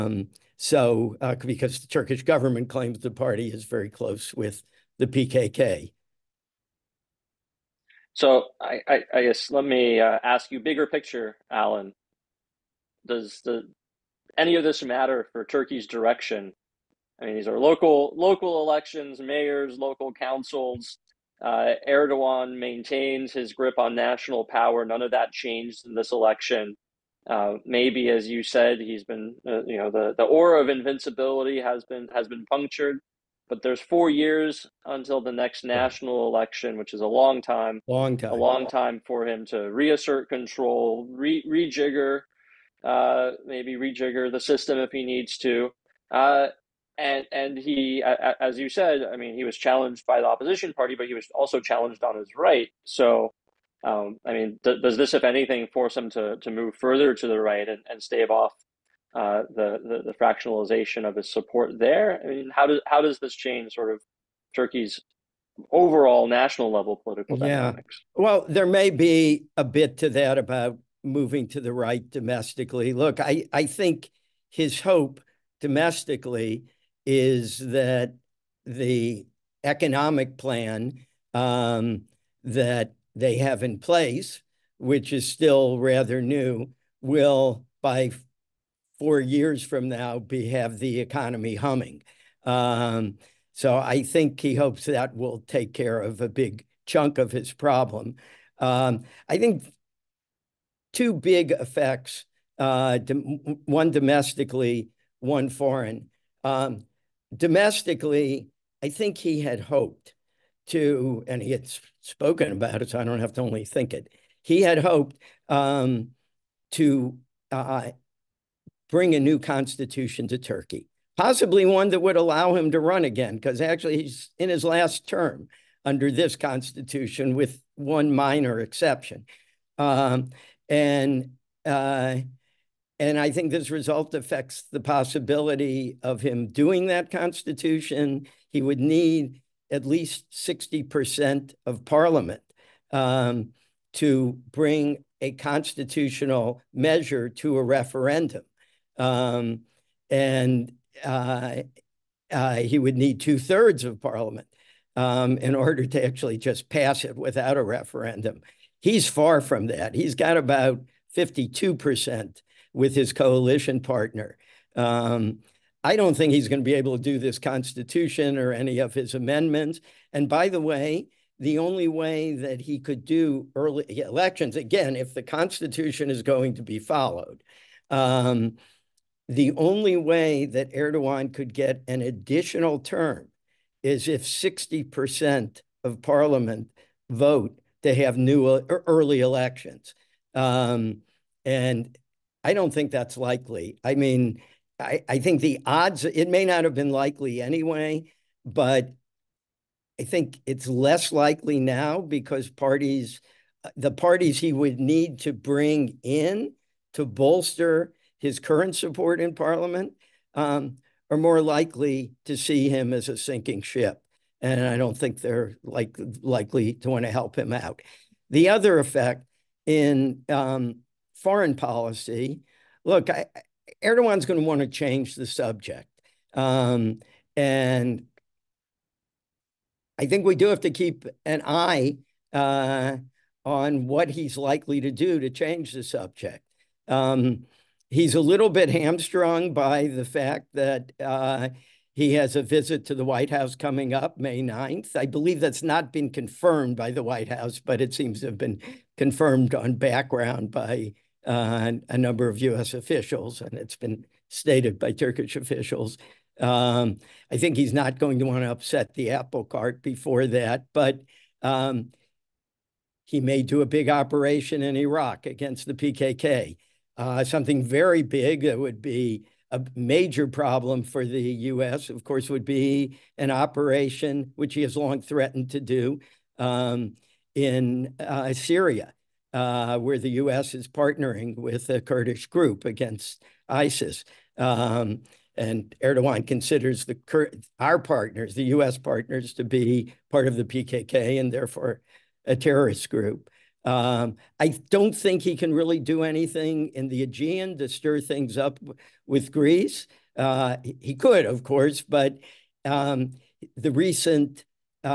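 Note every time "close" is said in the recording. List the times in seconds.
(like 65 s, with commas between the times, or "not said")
3 s.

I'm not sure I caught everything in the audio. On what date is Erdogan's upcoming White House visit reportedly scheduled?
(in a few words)
May 9.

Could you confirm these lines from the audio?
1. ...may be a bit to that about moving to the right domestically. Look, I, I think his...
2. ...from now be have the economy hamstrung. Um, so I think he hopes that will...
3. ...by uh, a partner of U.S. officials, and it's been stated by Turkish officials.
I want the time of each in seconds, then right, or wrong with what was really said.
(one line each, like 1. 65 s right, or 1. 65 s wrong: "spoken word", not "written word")
1. 68 s right
2. 89 s wrong: "humming", not "hamstrung"
3. 250 s wrong: "number", not "partner".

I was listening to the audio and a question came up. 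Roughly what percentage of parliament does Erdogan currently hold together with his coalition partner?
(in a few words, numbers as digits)
52%.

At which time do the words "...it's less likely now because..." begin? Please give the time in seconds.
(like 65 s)
200 s.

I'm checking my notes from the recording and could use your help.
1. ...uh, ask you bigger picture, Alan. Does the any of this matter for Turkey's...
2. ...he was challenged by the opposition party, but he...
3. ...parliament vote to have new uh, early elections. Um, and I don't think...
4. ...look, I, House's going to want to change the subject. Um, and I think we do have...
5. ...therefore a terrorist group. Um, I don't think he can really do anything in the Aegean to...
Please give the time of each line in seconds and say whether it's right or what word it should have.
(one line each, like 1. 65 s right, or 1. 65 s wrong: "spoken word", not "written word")
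1. 9 s right
2. 49 s right
3. 186 s right
4. 222 s wrong: "Erdogan", not "House"
5. 291 s right.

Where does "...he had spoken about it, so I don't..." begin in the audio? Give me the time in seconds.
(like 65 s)
111 s.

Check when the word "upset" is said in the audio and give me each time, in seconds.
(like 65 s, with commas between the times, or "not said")
258 s.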